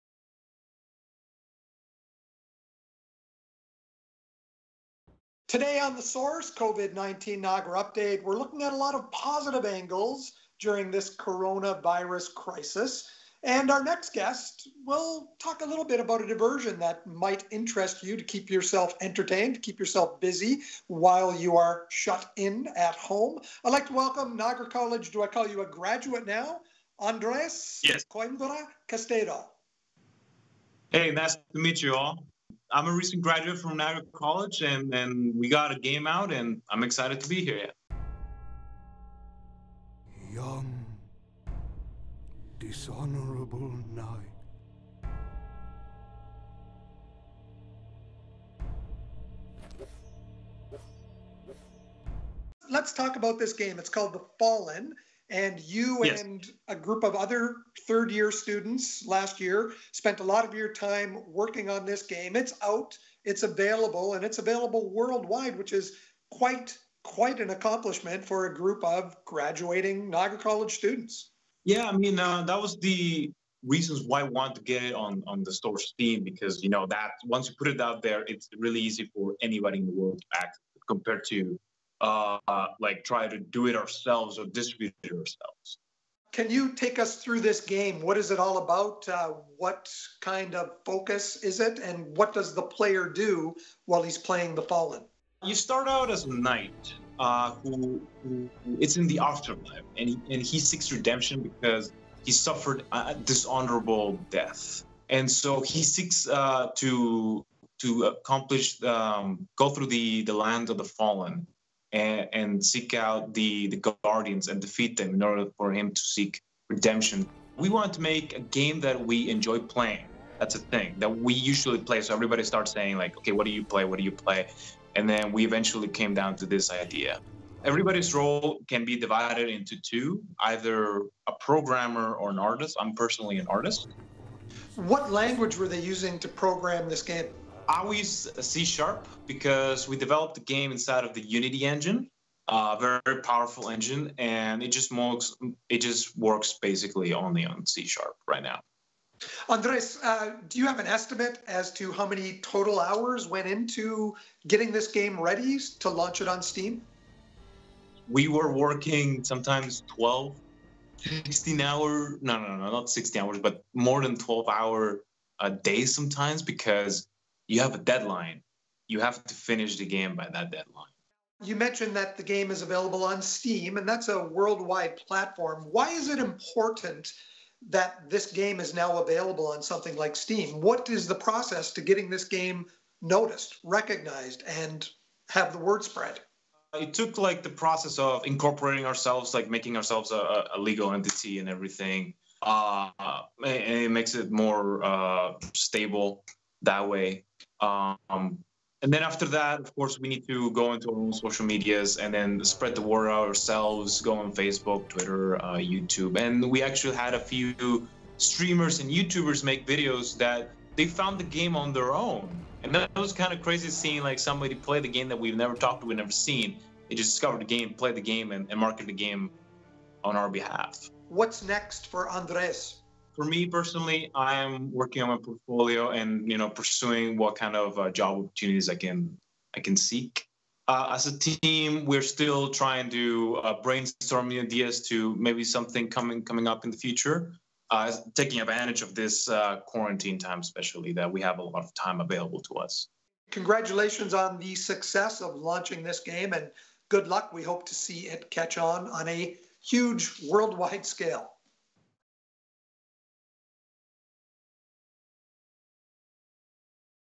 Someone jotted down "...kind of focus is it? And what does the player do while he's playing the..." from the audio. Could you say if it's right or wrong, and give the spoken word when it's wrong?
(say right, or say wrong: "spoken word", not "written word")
right.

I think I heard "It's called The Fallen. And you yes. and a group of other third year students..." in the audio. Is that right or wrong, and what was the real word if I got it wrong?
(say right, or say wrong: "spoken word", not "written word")
right.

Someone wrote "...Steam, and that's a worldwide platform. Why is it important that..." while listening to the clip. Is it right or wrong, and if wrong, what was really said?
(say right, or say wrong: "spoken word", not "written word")
right.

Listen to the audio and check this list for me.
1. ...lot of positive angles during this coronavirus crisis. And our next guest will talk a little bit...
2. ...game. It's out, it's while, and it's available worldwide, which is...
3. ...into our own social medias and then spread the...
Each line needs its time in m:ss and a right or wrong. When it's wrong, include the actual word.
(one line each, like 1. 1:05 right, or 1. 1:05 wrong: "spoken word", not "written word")
1. 0:08 right
2. 1:02 wrong: "available", not "while"
3. 3:20 right.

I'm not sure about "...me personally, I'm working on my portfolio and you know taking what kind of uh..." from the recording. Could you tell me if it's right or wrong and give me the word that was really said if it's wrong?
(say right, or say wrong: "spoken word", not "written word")
wrong: "pursuing", not "taking".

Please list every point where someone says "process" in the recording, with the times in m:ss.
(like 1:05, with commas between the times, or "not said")
3:01, 3:07.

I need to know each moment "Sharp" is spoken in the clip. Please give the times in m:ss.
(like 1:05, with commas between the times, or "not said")
2:18, 2:27.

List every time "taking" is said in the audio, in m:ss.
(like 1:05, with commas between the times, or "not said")
3:58.